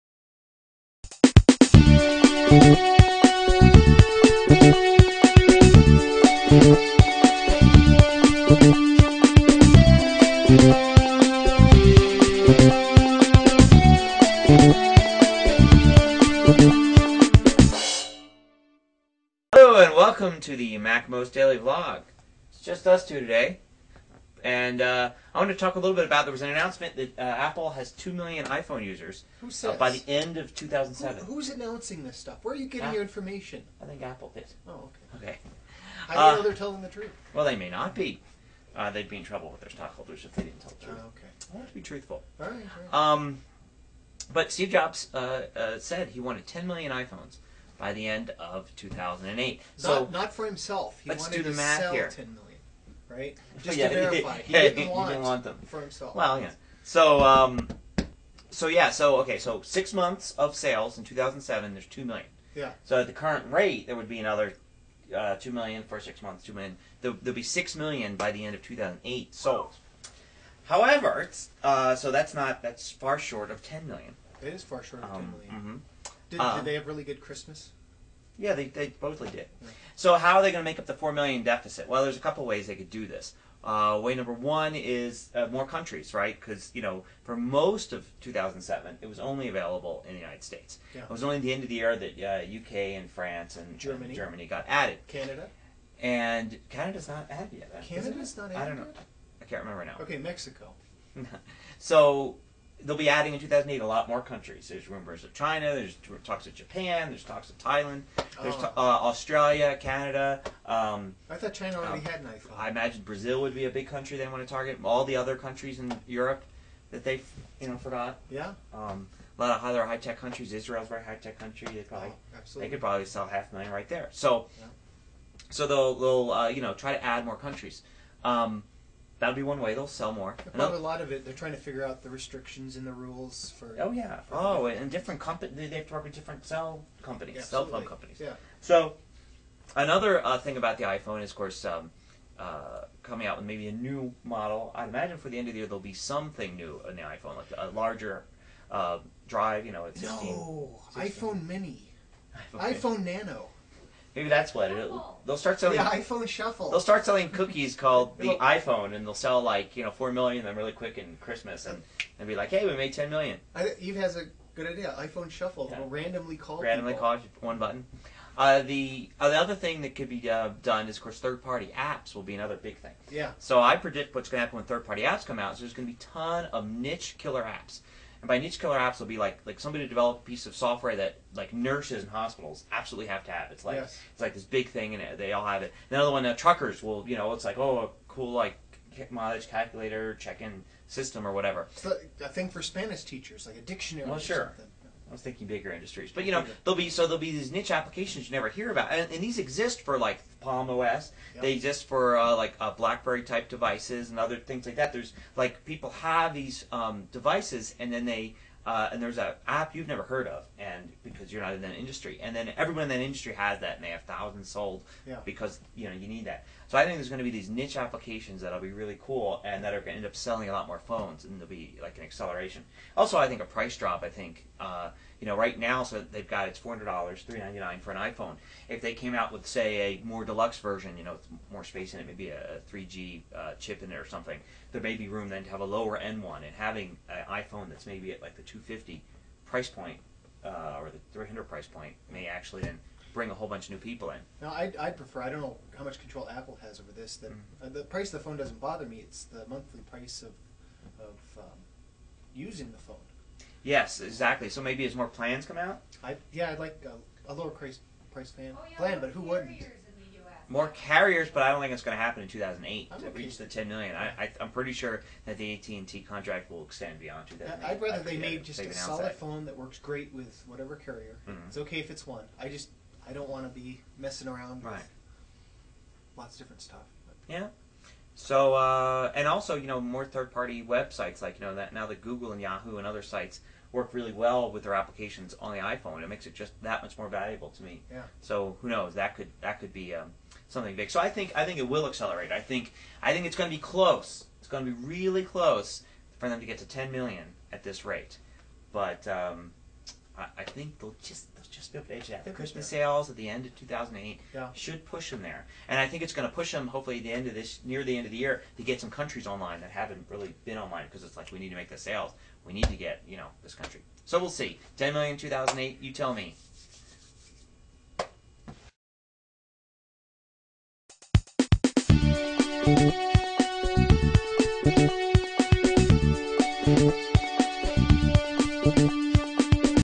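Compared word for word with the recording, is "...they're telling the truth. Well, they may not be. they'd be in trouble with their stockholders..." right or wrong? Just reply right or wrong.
right.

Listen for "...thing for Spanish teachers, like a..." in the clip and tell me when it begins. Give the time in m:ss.
3:12.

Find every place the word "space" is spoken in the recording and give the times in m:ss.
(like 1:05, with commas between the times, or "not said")
3:51.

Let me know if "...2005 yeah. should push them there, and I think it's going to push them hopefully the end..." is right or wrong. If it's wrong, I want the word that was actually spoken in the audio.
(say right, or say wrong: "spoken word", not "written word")
wrong: "2008", not "2005".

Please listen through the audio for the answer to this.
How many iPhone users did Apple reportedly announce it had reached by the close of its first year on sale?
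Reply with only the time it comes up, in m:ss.
0:27.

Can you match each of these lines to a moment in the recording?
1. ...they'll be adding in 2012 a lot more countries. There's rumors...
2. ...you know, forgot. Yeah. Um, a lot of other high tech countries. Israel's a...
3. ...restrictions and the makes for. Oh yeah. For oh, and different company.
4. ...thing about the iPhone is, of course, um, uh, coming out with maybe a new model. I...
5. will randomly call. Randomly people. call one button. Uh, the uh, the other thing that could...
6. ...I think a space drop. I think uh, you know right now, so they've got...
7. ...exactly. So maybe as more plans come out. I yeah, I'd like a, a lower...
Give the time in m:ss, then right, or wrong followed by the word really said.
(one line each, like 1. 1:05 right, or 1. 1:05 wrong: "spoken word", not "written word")
1. 1:42 wrong: "2008", not "2012"
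2. 1:57 right
3. 2:12 wrong: "rules", not "makes"
4. 2:20 right
5. 2:45 right
6. 3:43 wrong: "price", not "space"
7. 4:14 right.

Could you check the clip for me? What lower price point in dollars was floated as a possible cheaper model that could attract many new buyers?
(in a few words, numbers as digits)
$250.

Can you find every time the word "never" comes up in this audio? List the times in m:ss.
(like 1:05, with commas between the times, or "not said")
3:18, 3:29.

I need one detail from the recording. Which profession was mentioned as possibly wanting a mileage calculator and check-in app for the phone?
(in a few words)
truckers.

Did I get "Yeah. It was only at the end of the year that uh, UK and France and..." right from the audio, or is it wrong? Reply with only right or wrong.
right.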